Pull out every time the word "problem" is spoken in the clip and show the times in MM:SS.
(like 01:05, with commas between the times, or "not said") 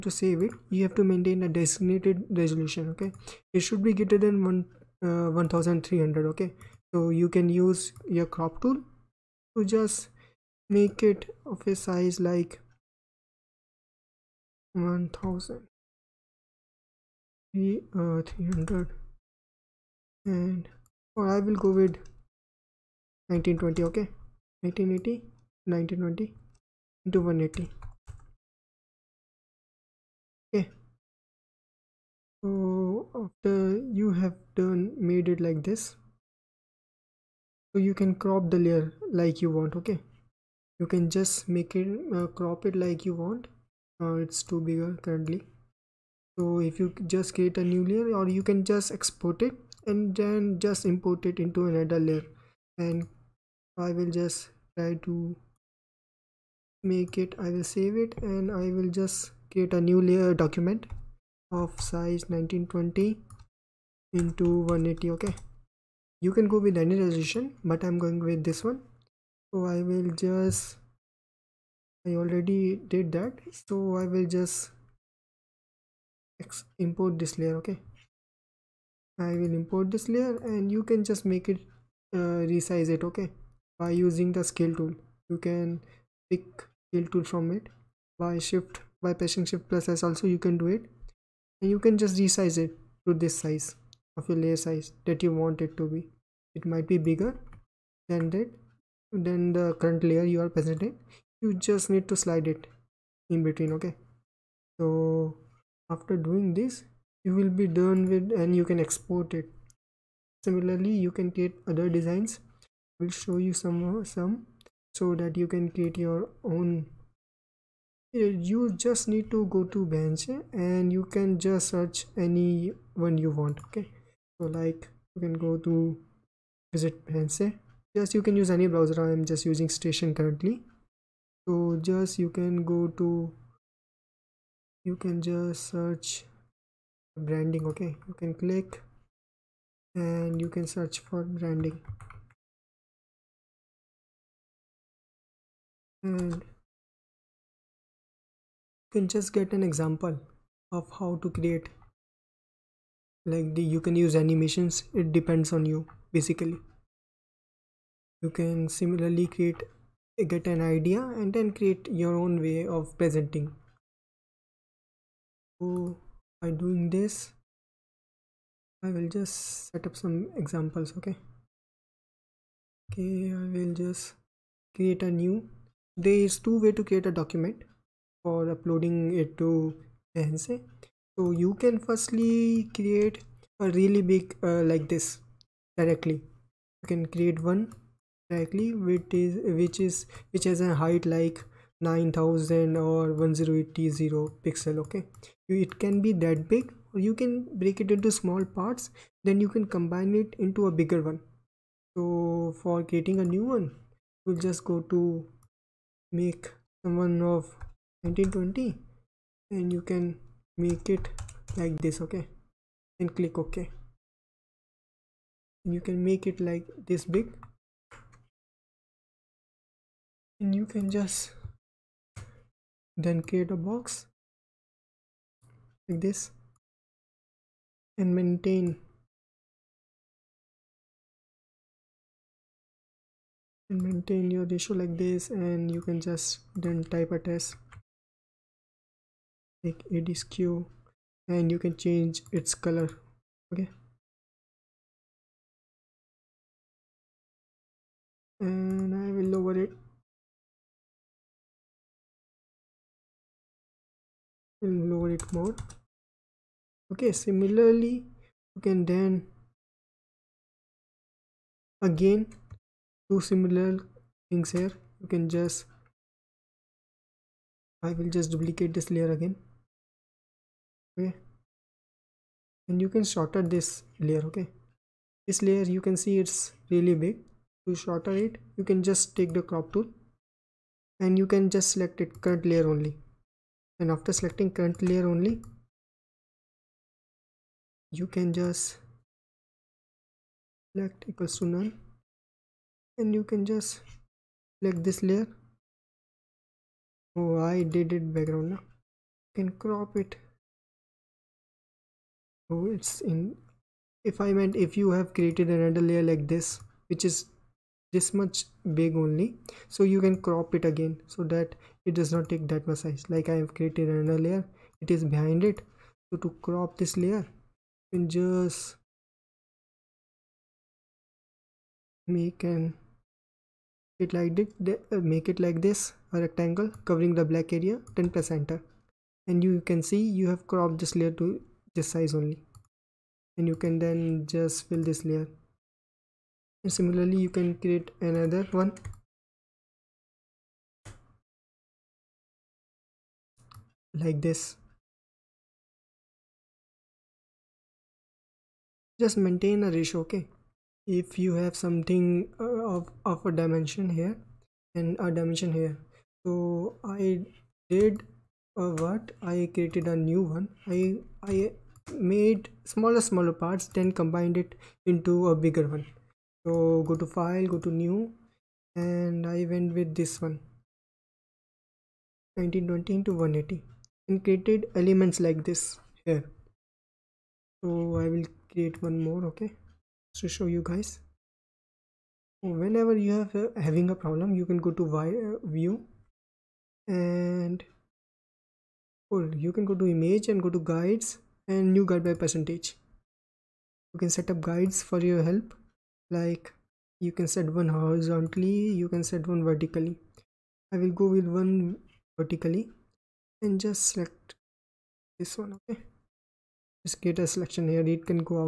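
06:23.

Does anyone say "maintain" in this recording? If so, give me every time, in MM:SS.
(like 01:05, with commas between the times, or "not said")
00:01, 03:48, 03:53, 05:49.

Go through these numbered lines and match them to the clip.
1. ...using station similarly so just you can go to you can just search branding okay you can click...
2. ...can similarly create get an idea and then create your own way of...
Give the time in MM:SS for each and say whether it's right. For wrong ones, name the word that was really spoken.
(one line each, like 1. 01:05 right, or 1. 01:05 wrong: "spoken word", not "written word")
1. 02:09 wrong: "currently", not "similarly"
2. 02:38 right.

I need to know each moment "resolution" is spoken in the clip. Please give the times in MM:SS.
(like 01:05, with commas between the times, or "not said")
00:02, 01:06.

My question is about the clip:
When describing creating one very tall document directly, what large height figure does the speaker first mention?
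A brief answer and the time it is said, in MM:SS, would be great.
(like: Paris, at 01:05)
9000, at 03:11.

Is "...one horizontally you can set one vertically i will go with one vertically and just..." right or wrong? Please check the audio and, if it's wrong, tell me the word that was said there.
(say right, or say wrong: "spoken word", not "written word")
right.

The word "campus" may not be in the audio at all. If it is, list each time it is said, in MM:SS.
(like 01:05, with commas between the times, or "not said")
not said.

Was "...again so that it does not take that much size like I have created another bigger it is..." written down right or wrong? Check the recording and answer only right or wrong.
wrong.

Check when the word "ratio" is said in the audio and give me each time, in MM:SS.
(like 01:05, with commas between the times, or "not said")
03:54, 05:49.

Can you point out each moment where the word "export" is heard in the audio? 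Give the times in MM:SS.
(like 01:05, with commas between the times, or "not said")
00:48, 01:48.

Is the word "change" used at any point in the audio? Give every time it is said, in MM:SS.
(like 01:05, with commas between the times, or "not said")
04:01.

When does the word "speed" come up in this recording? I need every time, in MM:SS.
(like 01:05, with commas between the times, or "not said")
not said.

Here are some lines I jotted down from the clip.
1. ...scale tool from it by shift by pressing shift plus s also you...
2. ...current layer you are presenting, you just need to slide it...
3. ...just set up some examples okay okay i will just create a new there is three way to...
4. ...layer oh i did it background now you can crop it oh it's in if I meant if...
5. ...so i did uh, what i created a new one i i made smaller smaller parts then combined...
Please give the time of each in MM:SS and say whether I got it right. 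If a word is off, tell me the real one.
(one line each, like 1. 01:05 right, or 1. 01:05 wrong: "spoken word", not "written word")
1. 01:26 right
2. 01:39 right
3. 02:49 wrong: "two", not "three"
4. 04:55 right
5. 05:56 right.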